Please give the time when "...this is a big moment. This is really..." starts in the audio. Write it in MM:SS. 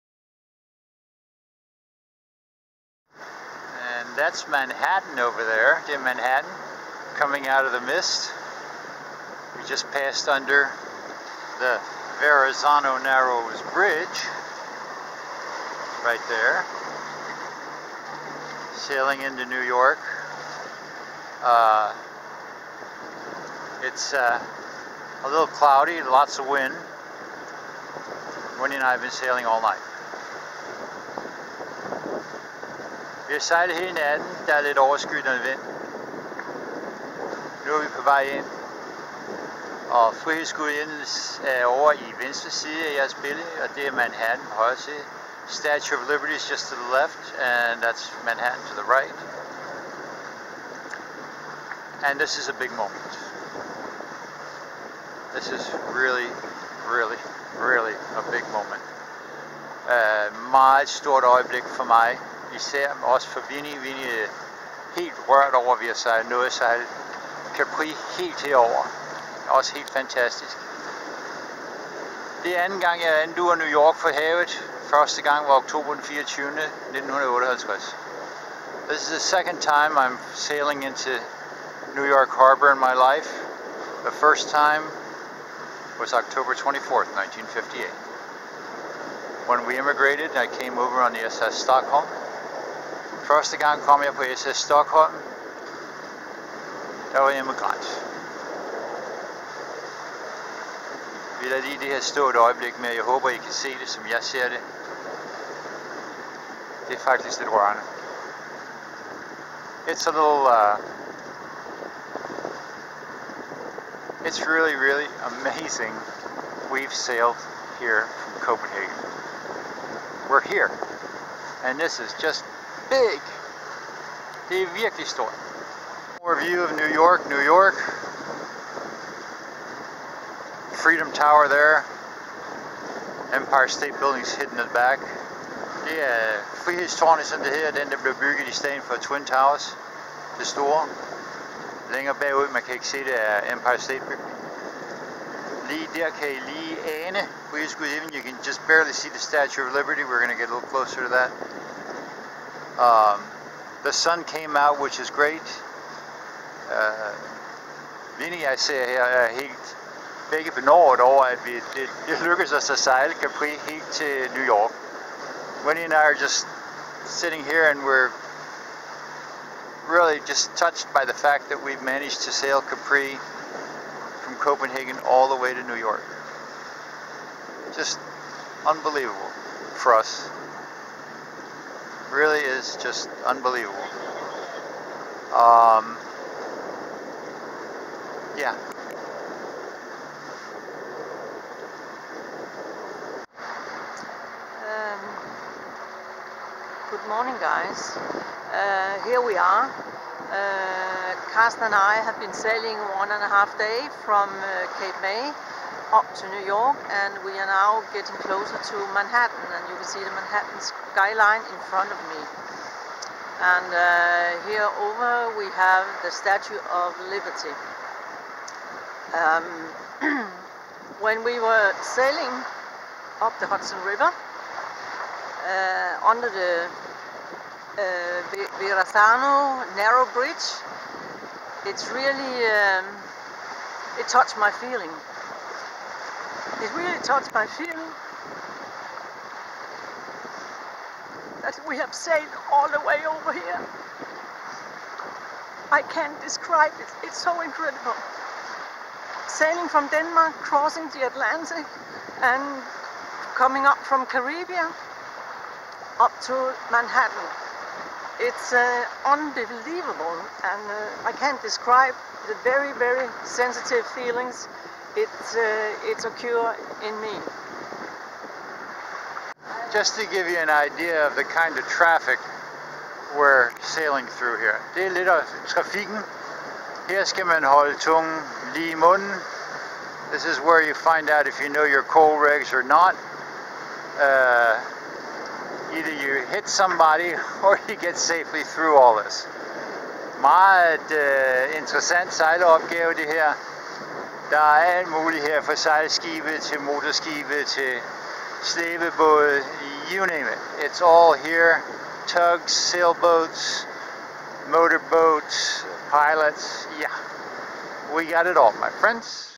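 00:52.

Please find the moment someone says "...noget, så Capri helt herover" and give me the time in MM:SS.
01:06.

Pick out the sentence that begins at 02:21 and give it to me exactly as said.
Længere bagud, man kan ikke se det, er Empire State Building.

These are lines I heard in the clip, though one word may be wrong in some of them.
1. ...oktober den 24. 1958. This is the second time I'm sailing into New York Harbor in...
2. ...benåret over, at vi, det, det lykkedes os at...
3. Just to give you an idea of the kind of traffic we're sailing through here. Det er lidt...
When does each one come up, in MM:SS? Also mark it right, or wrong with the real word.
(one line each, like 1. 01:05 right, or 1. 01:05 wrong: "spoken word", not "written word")
1. 01:15 right
2. 02:40 right
3. 04:29 right.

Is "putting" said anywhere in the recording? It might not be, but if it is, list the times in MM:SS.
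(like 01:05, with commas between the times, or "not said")
not said.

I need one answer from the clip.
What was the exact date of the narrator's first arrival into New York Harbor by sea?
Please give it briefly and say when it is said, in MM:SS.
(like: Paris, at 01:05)
October 24, 1958, at 01:26.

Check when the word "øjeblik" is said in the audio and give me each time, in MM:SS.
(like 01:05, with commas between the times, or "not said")
01:01, 01:42.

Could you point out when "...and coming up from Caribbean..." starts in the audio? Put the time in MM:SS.
04:12.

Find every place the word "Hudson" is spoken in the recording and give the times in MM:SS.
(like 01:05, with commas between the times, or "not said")
03:43.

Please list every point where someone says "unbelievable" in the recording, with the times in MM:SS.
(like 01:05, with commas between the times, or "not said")
02:58, 03:03, 04:19.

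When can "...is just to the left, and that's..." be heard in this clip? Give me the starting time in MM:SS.
00:46.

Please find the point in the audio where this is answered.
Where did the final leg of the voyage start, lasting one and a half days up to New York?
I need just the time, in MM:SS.
03:24.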